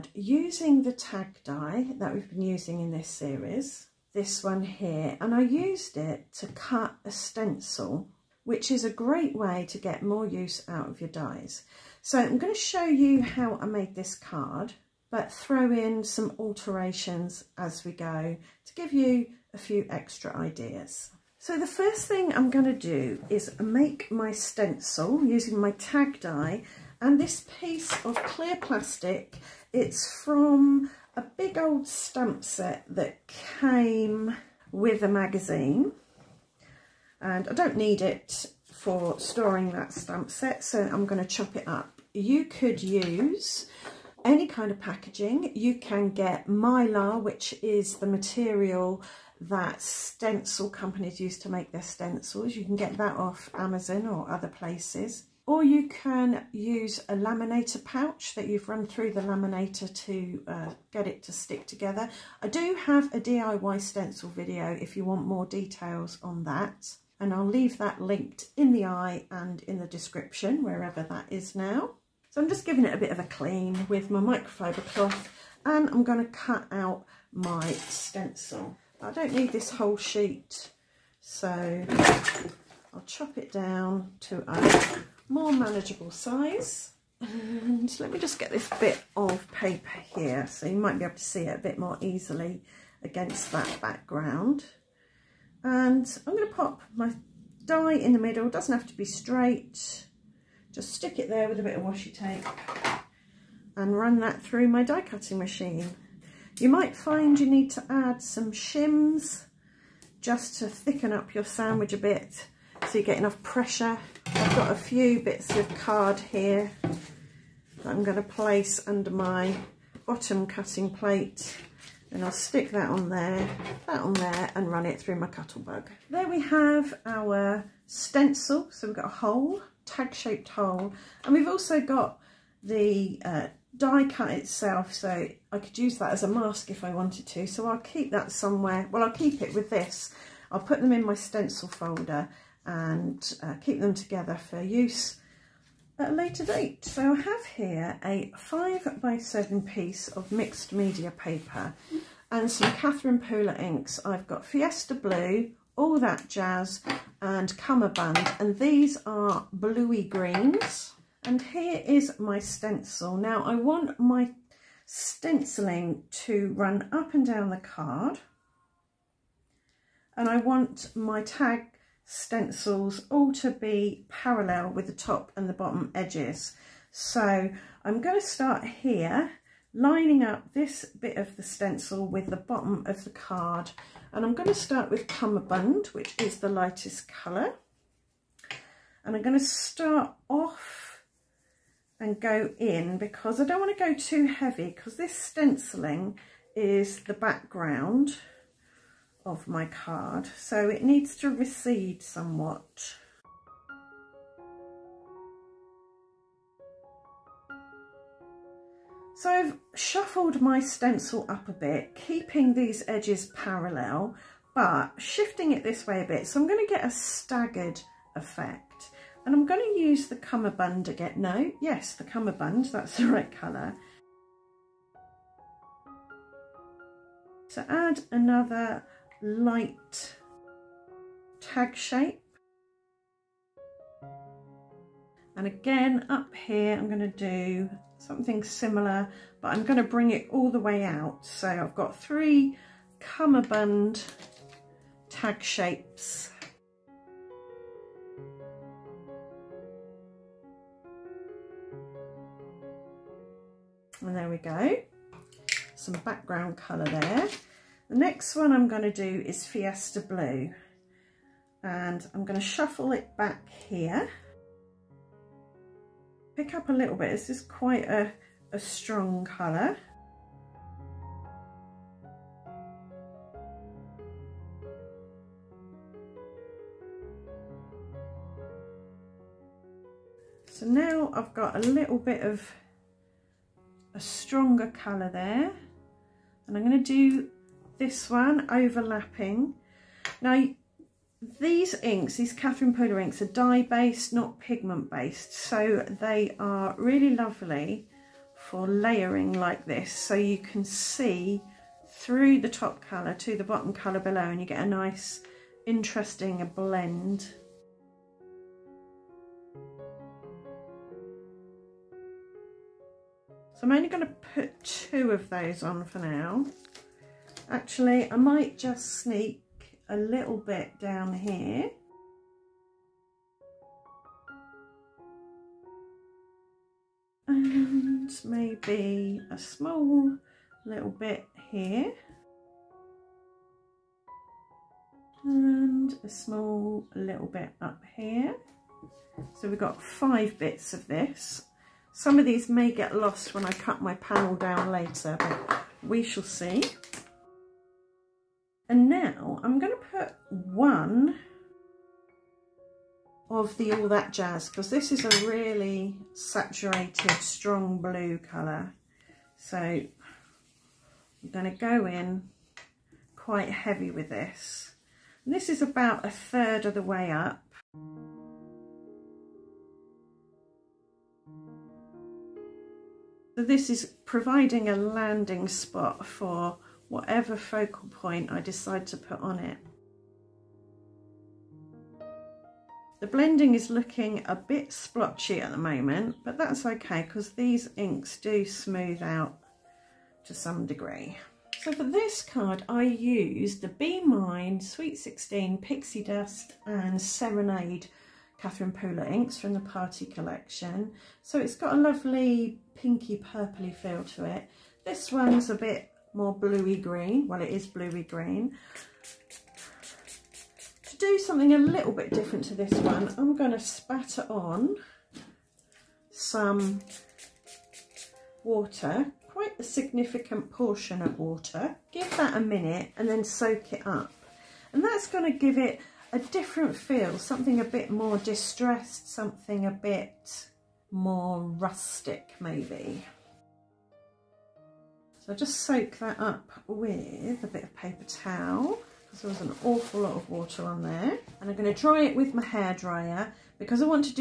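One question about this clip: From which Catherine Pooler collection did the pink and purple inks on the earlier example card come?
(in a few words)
Party Collection.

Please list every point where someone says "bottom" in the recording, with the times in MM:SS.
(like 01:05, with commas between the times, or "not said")
02:00, 02:55, 03:02, 05:03.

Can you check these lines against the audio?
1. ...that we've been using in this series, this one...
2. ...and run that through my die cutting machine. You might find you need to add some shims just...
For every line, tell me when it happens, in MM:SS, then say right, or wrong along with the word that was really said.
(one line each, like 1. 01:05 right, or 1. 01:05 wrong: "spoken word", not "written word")
1. 00:01 right
2. 01:43 right.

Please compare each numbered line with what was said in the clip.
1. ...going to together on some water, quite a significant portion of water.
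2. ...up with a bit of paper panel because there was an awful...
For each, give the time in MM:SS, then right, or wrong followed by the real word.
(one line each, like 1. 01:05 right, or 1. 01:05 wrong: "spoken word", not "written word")
1. 06:53 wrong: "spatter", not "together"
2. 07:16 wrong: "towel", not "panel".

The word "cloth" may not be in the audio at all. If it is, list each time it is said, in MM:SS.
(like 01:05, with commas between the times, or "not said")
01:14.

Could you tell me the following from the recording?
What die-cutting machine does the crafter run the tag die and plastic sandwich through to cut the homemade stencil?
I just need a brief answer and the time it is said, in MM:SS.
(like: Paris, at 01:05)
Cuttlebug, at 02:05.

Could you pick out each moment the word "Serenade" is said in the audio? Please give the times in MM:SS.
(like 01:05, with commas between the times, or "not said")
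06:37.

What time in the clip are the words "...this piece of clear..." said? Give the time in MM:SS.
00:27.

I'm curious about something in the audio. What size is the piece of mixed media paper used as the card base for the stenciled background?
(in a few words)
5 by 7.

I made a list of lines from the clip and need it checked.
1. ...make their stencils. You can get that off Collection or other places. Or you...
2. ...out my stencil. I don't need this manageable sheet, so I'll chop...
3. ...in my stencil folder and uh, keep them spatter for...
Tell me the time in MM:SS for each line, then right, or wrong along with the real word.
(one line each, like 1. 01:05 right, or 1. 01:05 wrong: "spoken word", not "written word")
1. 00:51 wrong: "Amazon", not "Collection"
2. 01:16 wrong: "whole", not "manageable"
3. 02:20 wrong: "together", not "spatter".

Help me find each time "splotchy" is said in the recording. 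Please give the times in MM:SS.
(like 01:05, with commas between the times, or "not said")
06:24.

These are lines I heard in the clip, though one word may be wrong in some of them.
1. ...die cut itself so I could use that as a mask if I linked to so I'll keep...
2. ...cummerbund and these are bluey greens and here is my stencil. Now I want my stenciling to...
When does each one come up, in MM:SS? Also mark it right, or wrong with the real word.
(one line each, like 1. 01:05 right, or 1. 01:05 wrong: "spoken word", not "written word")
1. 02:13 wrong: "wanted", not "linked"
2. 02:37 right.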